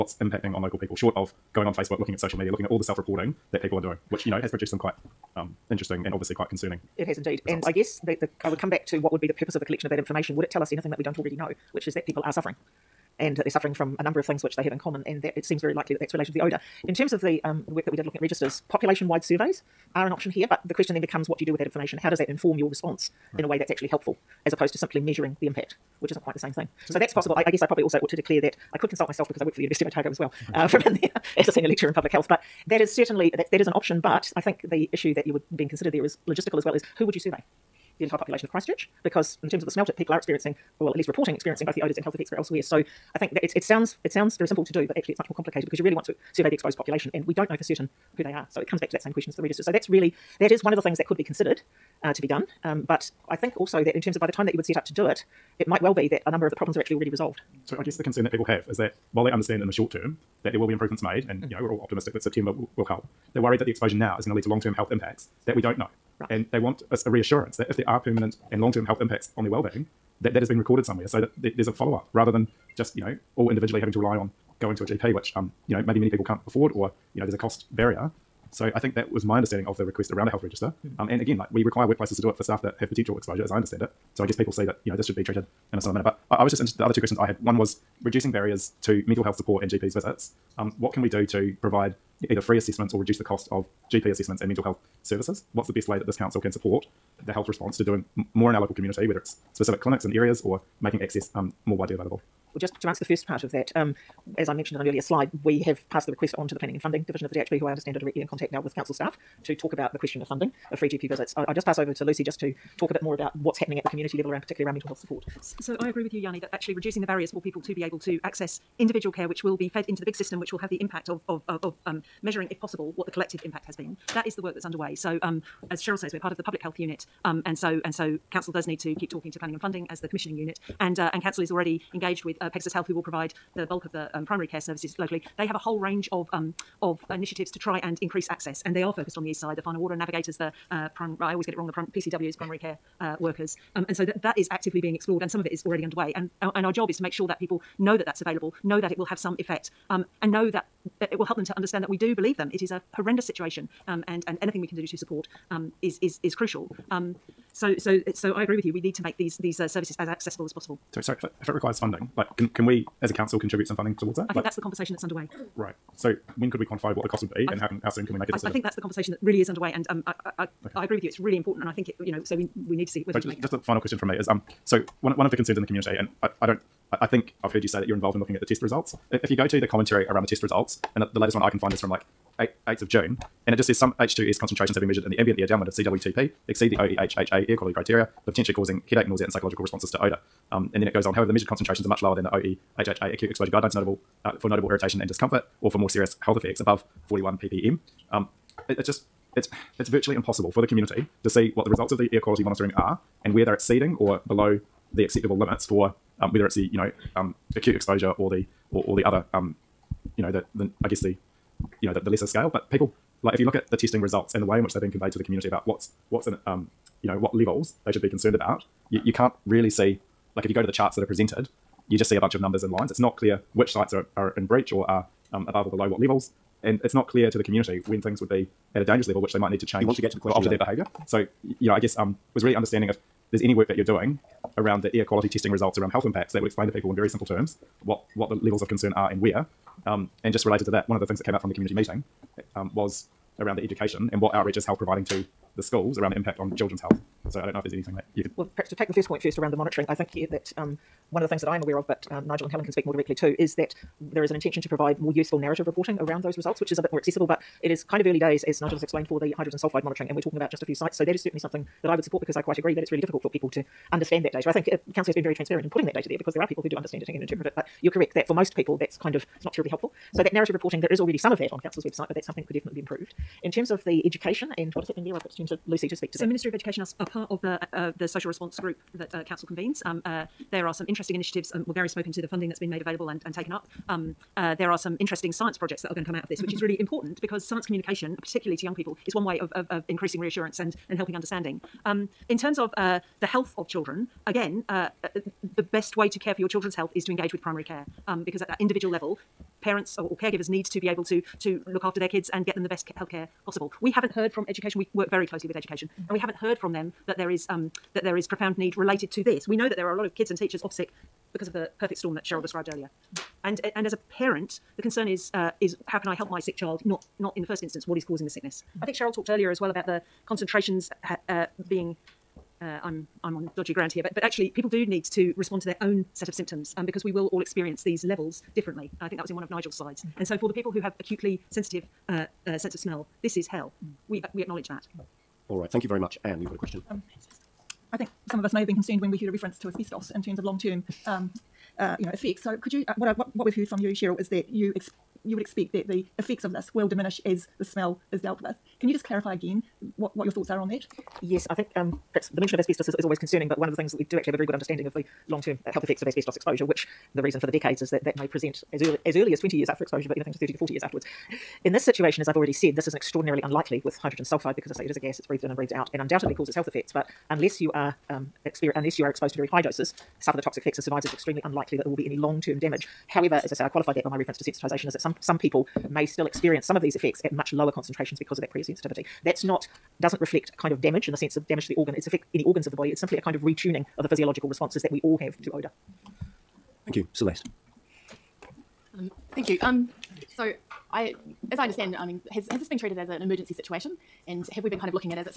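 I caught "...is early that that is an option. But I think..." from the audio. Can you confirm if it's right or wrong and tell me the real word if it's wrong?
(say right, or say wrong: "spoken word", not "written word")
wrong: "certainly", not "early".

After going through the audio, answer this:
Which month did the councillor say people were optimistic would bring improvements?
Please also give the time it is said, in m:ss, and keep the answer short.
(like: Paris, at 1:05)
September, at 1:02.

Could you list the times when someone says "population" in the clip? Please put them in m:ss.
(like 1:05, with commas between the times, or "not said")
0:18, 0:38, 0:46.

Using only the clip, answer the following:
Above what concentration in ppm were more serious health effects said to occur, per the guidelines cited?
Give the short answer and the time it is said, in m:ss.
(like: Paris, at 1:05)
41 ppm, at 3:17.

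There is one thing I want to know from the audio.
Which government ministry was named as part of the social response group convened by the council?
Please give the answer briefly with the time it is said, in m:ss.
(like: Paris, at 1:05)
Ministry of Education, at 4:36.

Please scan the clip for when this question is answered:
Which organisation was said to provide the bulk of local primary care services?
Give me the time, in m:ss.
2:12.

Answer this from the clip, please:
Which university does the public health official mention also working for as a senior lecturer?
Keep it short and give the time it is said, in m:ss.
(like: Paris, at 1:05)
University of Otago, at 0:29.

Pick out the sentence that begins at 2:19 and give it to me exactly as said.
The final order and navigators, the uh, I always get it wrong.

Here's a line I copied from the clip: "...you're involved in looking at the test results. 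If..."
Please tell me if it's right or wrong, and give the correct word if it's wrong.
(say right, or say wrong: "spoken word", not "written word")
right.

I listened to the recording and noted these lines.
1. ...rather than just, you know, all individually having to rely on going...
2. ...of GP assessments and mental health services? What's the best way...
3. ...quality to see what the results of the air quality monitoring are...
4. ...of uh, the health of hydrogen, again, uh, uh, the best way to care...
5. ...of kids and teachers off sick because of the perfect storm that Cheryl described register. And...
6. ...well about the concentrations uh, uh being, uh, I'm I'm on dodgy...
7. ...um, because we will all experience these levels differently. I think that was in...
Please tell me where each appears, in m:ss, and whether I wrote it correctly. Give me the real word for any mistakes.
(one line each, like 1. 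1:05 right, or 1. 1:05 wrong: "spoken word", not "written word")
1. 1:12 right
2. 1:33 right
3. 3:20 wrong: "community", not "quality"
4. 4:52 wrong: "children", not "hydrogen"
5. 5:10 wrong: "earlier", not "register"
6. 5:19 right
7. 5:26 right.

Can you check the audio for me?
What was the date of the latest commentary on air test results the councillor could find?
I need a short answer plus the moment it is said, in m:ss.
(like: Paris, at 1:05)
8 June, at 3:02.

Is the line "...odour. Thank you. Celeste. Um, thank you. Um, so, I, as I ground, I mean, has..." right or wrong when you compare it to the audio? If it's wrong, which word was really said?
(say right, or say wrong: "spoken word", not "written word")
wrong: "understand", not "ground".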